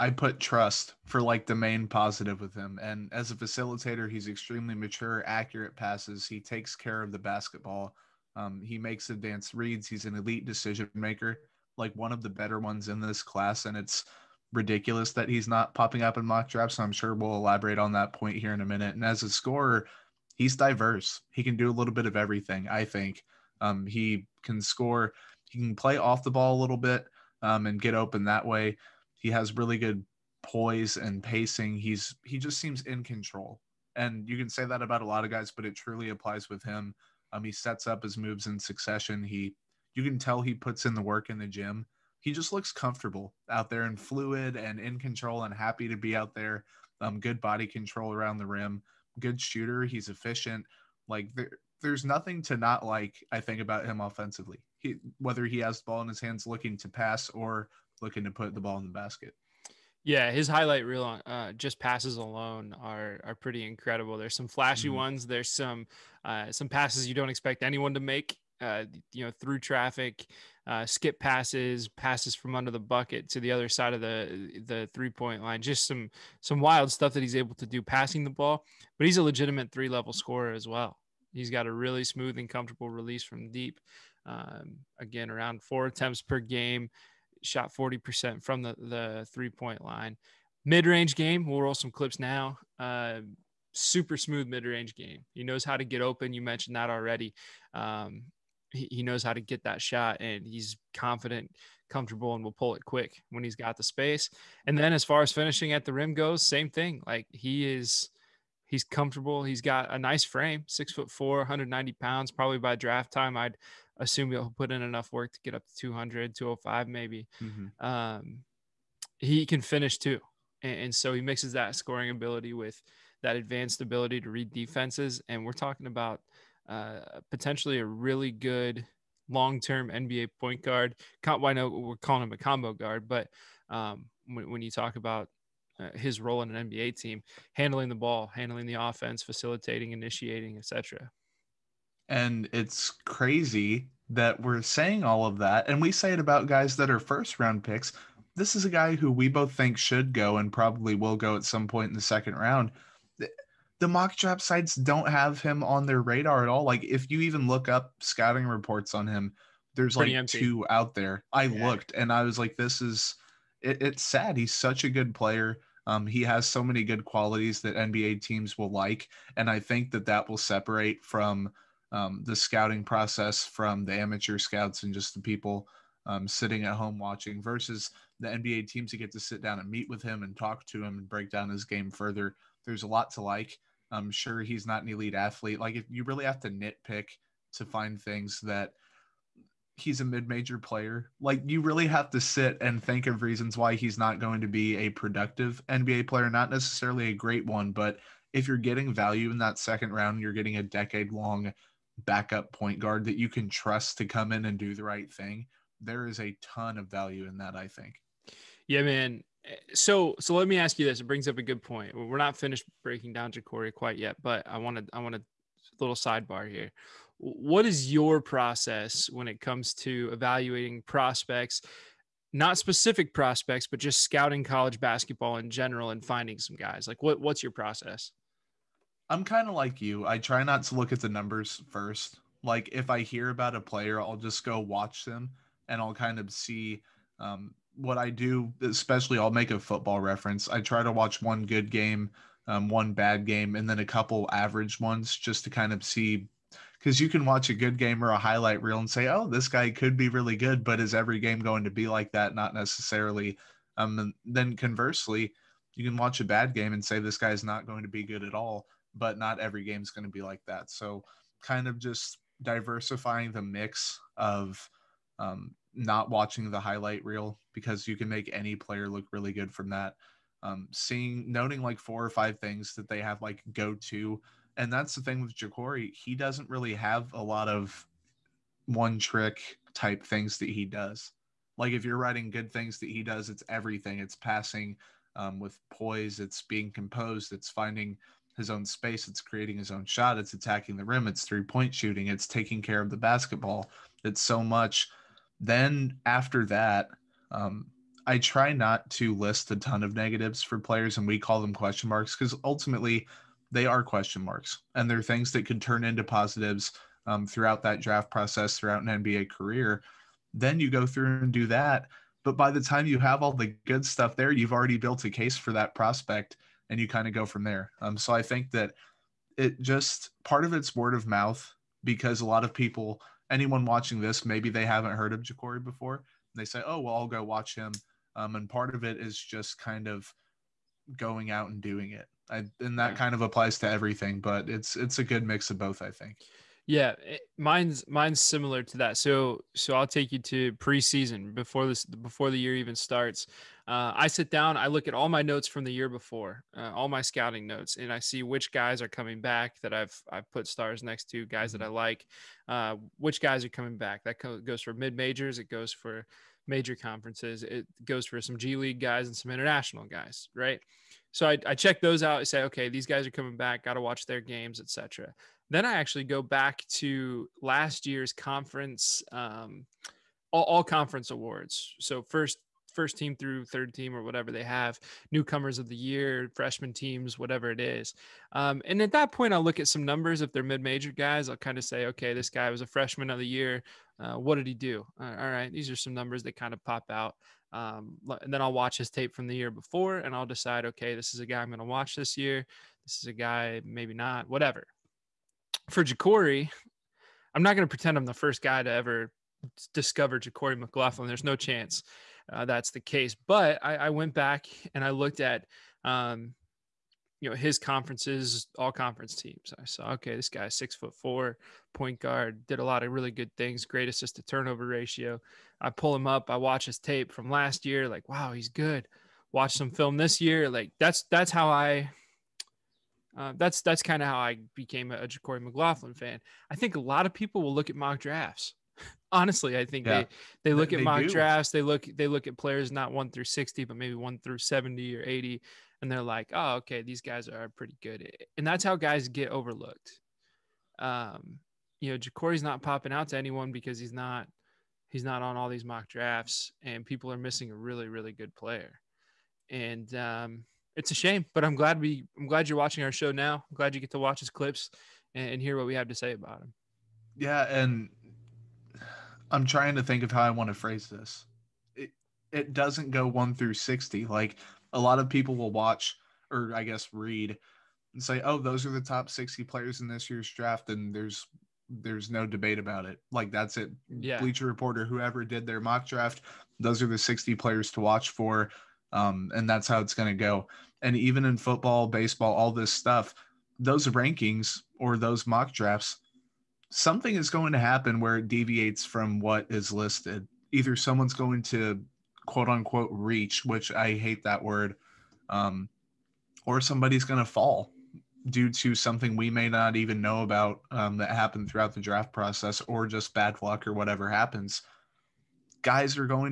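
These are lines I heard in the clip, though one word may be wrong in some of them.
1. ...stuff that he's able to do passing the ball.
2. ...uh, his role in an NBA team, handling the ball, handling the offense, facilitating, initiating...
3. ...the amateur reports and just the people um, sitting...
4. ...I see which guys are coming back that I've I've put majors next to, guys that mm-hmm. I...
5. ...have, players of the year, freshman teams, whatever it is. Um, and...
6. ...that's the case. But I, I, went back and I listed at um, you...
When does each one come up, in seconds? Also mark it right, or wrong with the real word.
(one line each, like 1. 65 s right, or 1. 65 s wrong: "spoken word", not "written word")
1. 76 s right
2. 135 s right
3. 173 s wrong: "scouts", not "reports"
4. 347 s wrong: "stars", not "majors"
5. 374 s wrong: "newcomers", not "players"
6. 402 s wrong: "looked", not "listed".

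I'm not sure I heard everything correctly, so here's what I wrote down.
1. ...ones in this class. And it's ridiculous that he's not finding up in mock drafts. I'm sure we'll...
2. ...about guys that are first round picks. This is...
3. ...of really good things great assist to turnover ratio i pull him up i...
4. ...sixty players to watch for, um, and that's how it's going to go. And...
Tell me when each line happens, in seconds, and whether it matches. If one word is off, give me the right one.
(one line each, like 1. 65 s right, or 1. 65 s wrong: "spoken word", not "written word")
1. 12 s wrong: "popping", not "finding"
2. 146 s right
3. 412 s right
4. 476 s right.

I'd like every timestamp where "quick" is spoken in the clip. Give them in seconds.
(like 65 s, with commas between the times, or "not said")
102 s.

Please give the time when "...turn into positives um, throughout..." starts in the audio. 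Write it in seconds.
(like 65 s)
305 s.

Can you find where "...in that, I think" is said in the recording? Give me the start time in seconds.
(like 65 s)
207 s.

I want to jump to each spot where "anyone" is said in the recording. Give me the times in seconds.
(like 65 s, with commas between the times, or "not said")
67 s, 323 s, 443 s.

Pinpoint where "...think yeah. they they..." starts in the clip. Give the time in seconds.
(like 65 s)
429 s.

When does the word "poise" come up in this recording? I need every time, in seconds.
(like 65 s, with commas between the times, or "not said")
30 s, 285 s.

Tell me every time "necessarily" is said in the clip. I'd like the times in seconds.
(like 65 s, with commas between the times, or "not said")
196 s, 252 s.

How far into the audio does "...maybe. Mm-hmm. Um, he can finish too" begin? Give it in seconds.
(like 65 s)
116 s.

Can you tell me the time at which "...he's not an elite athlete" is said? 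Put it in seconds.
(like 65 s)
184 s.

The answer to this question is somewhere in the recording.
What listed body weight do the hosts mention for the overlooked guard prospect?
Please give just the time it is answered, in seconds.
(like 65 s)
111 s.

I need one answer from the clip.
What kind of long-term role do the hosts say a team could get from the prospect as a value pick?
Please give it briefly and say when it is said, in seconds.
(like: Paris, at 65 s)
Backup point guard, at 202 s.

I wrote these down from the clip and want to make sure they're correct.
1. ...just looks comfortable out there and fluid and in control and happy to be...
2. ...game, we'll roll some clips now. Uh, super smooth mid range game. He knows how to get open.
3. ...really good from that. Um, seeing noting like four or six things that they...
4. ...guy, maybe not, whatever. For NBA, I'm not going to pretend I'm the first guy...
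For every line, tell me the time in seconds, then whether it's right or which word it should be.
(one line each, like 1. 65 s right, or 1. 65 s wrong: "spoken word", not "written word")
1. 42 s right
2. 91 s right
3. 269 s wrong: "five", not "six"
4. 393 s wrong: "JaQuori", not "NBA".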